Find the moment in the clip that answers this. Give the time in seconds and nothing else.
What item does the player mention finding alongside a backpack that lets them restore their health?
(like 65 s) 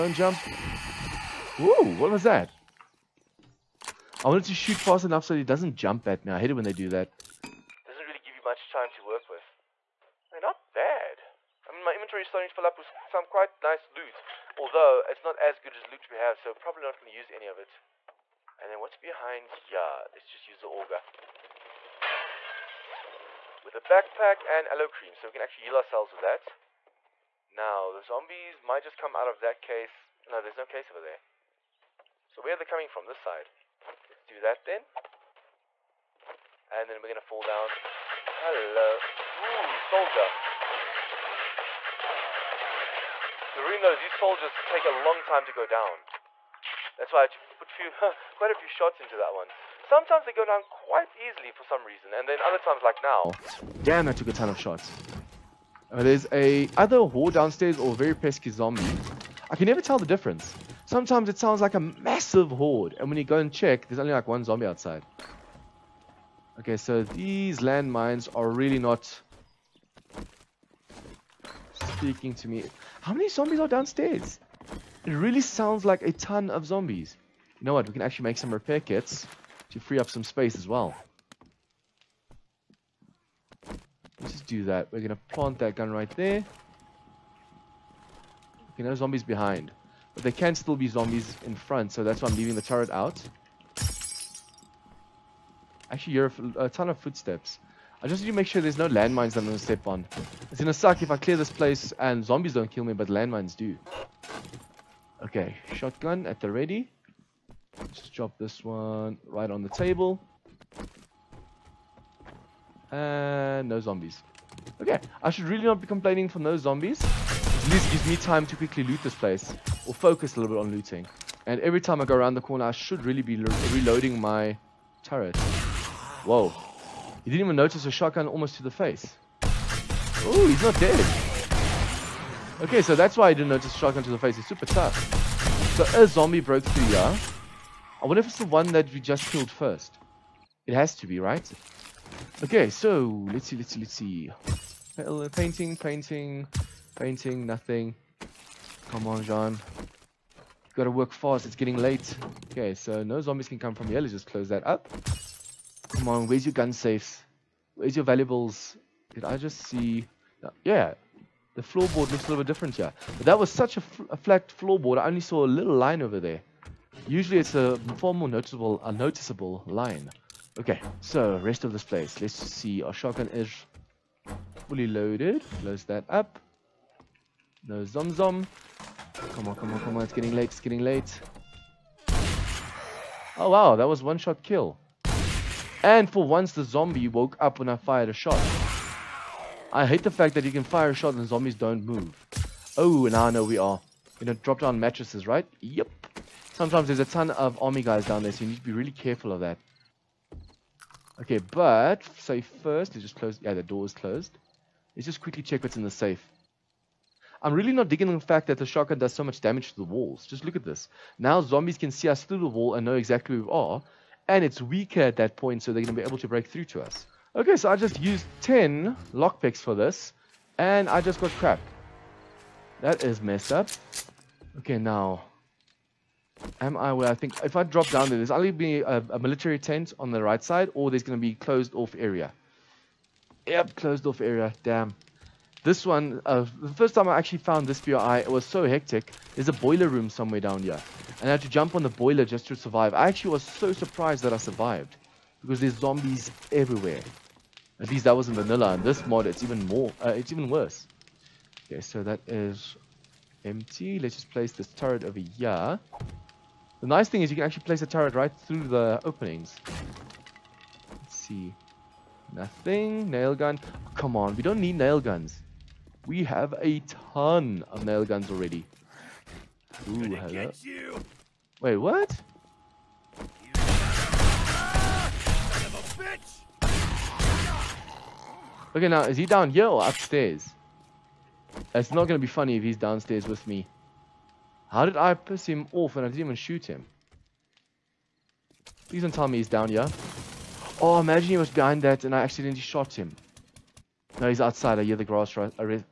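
24 s.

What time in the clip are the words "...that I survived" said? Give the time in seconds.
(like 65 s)
244 s.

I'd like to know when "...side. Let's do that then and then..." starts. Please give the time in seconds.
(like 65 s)
33 s.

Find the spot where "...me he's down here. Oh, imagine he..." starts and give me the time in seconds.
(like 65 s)
289 s.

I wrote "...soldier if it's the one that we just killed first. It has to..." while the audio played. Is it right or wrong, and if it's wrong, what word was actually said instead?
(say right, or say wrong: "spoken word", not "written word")
wrong: "wonder", not "soldier".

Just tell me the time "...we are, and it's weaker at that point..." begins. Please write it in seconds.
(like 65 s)
213 s.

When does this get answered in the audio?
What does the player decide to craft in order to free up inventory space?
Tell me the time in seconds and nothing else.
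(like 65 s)
78 s.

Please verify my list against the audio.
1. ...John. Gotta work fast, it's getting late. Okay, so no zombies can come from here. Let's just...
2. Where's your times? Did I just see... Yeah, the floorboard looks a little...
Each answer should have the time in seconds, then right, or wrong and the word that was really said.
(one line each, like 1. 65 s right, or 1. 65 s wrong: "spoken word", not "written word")
1. 149 s right
2. 157 s wrong: "valuables", not "times".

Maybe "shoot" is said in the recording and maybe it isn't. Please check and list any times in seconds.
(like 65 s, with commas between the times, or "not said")
4 s, 286 s.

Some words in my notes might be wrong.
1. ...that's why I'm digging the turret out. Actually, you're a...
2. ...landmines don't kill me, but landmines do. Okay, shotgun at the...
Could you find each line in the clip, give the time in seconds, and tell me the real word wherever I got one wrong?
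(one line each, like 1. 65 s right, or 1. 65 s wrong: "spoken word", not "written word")
1. 92 s wrong: "leaving", not "digging"
2. 102 s wrong: "zombies", not "landmines".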